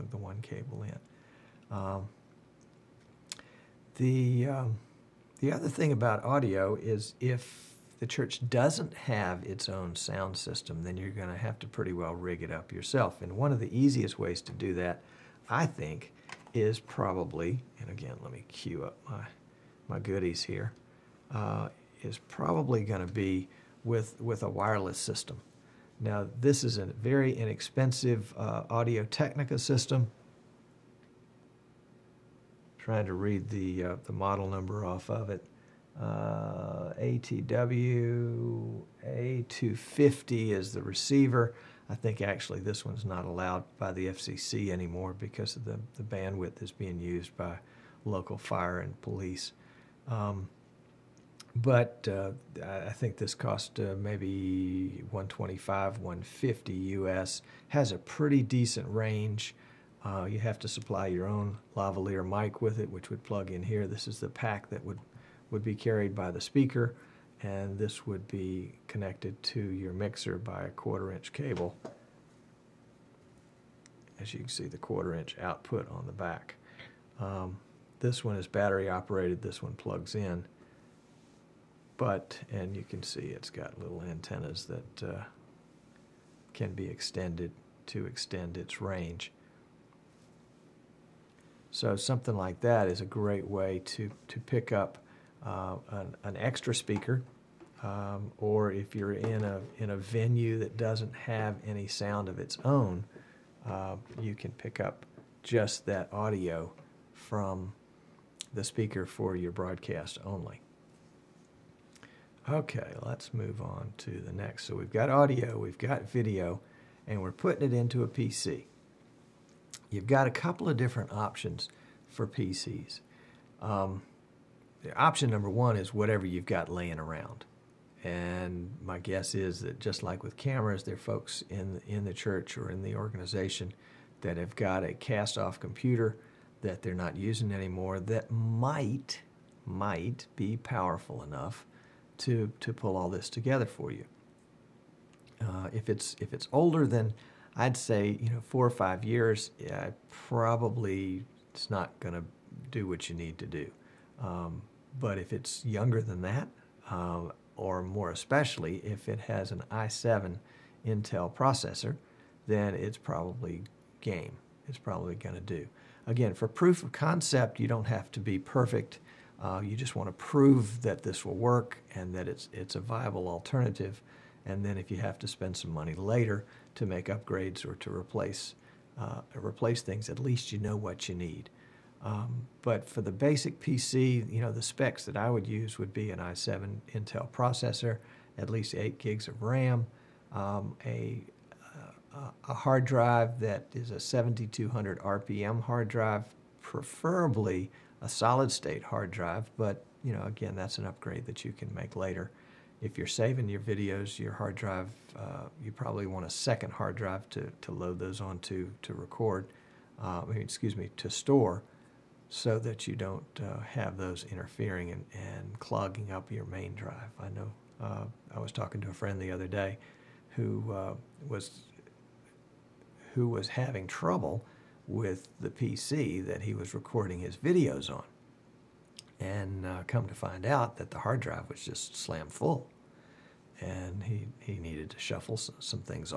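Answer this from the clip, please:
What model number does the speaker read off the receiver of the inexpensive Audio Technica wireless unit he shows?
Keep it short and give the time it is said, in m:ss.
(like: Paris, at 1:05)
ATW A250, at 0:37.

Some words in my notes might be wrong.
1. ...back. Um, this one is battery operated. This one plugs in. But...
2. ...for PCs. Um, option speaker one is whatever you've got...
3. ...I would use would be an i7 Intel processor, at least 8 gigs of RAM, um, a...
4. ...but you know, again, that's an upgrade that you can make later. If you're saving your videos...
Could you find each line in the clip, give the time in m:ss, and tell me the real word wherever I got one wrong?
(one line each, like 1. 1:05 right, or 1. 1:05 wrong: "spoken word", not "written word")
1. 1:16 right
2. 2:02 wrong: "number", not "speaker"
3. 3:05 right
4. 3:19 right.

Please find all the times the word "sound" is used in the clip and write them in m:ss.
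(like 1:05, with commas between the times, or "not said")
0:09, 1:41.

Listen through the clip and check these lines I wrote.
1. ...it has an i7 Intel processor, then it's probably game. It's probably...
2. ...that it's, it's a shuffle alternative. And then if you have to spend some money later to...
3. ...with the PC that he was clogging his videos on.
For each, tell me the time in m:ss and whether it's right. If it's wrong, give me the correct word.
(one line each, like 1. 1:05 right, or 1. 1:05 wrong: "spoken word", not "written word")
1. 2:39 right
2. 2:52 wrong: "viable", not "shuffle"
3. 3:44 wrong: "recording", not "clogging".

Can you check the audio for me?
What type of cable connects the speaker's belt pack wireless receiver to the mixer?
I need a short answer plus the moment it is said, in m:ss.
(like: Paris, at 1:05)
quarter-inch cable, at 1:10.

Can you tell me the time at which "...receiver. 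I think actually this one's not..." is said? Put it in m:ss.
0:40.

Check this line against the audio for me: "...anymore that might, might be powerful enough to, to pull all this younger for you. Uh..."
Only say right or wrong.
wrong.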